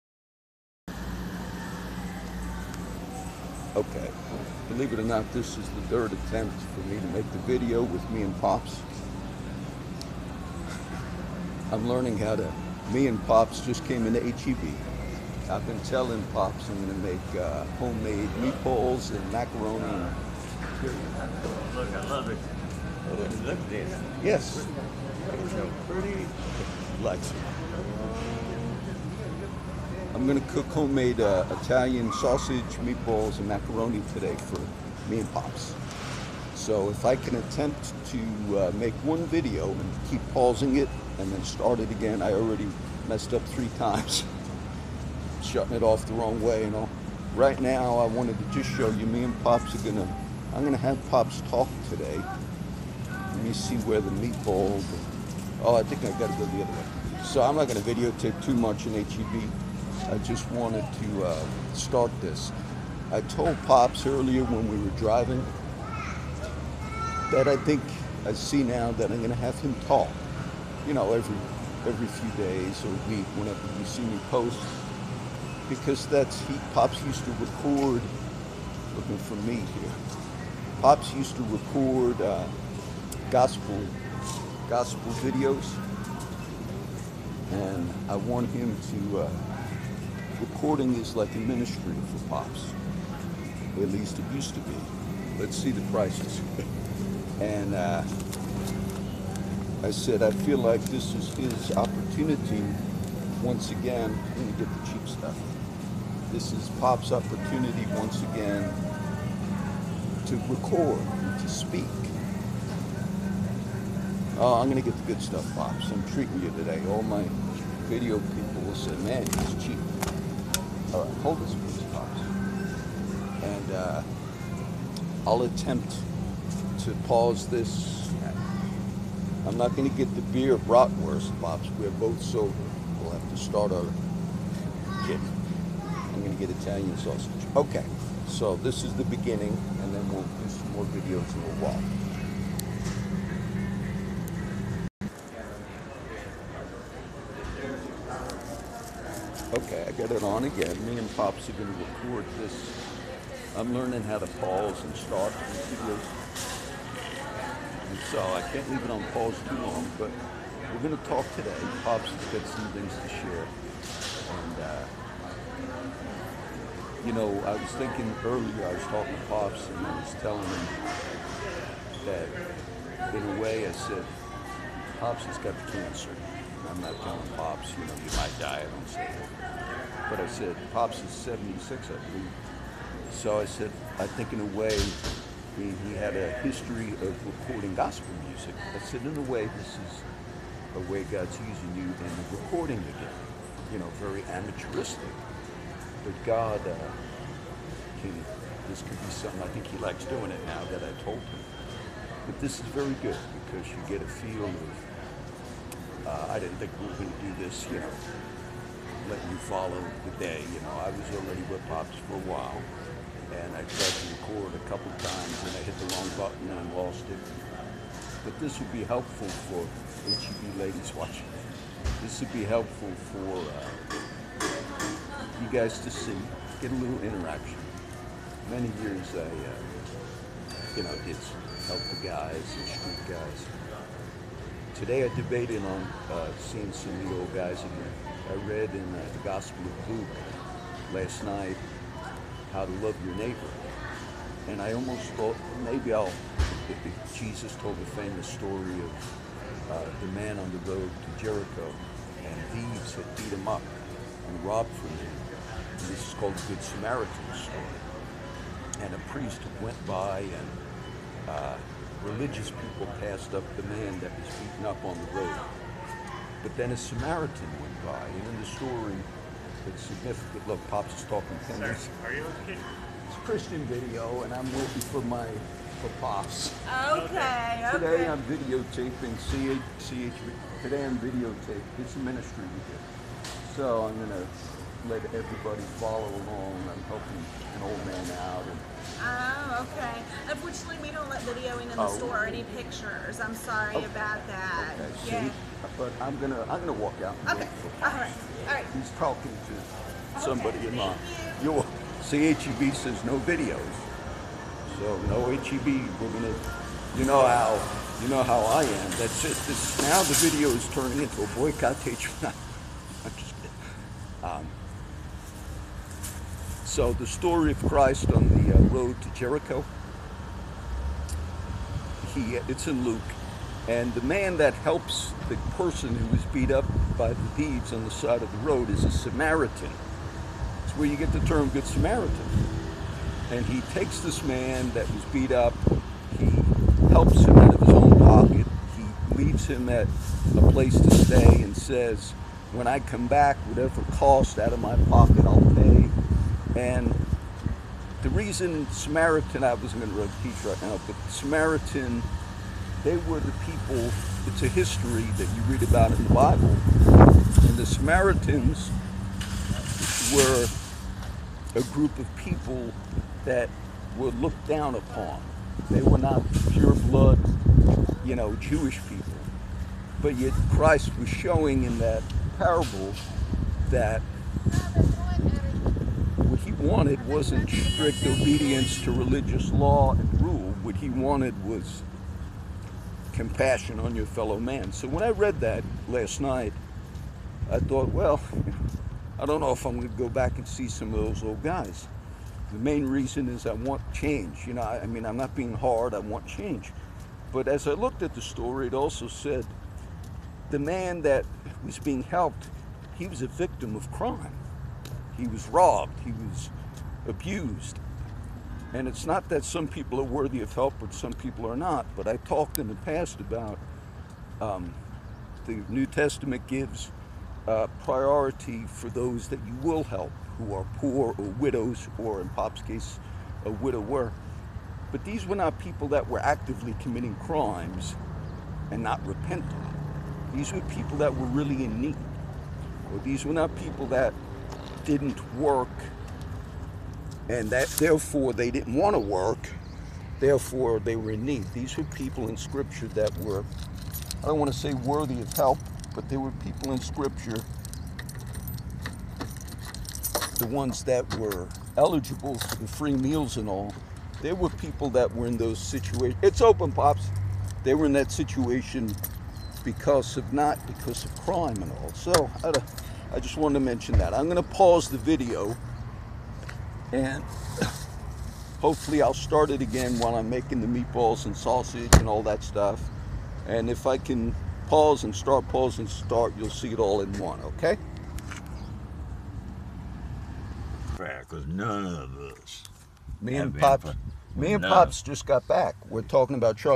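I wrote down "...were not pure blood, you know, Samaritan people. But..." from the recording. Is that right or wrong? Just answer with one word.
wrong.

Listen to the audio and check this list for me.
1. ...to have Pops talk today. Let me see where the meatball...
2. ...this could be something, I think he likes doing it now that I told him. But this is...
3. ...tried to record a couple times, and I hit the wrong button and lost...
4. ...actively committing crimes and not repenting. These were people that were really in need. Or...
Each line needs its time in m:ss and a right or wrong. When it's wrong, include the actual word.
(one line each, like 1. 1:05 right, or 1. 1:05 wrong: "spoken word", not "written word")
1. 0:50 right
2. 3:18 right
3. 3:33 right
4. 7:06 right.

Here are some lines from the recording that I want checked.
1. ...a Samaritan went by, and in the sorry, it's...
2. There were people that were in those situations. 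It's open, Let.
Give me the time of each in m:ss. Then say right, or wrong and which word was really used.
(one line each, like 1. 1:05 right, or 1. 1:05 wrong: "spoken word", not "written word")
1. 4:26 wrong: "story", not "sorry"
2. 7:34 wrong: "Pops", not "Let".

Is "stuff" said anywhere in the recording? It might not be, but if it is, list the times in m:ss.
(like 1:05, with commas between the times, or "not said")
1:45, 1:55, 7:52.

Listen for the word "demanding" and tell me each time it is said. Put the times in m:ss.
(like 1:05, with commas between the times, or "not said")
not said.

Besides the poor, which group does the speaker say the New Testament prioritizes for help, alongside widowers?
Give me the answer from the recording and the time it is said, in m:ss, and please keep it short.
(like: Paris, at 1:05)
Widows, at 7:01.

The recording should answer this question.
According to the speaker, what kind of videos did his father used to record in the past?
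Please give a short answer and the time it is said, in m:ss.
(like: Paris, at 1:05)
Gospel videos, at 1:24.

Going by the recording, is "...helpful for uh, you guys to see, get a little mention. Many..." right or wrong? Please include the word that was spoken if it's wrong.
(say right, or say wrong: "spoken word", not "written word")
wrong: "interaction", not "mention".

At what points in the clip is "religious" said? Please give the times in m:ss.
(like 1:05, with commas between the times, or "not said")
4:22, 6:18.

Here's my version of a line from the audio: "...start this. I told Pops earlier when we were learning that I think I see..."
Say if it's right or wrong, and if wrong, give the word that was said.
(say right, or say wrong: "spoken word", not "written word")
wrong: "driving", not "learning".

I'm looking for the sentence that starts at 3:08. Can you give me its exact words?
I said, in a way, this is a way God's using you in recording again.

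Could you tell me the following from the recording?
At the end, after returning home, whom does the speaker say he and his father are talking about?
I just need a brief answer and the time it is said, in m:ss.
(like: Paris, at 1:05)
Charlie, at 8:06.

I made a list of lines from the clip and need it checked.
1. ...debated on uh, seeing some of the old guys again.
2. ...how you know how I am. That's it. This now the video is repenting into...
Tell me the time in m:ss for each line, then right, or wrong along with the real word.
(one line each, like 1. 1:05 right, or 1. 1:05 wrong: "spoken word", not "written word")
1. 3:55 right
2. 5:07 wrong: "turning", not "repenting".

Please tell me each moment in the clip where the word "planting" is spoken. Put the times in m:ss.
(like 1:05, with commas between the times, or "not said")
not said.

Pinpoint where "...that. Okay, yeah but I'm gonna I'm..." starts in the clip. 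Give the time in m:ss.
4:54.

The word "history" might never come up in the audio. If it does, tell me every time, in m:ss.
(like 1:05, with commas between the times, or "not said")
3:06, 5:54.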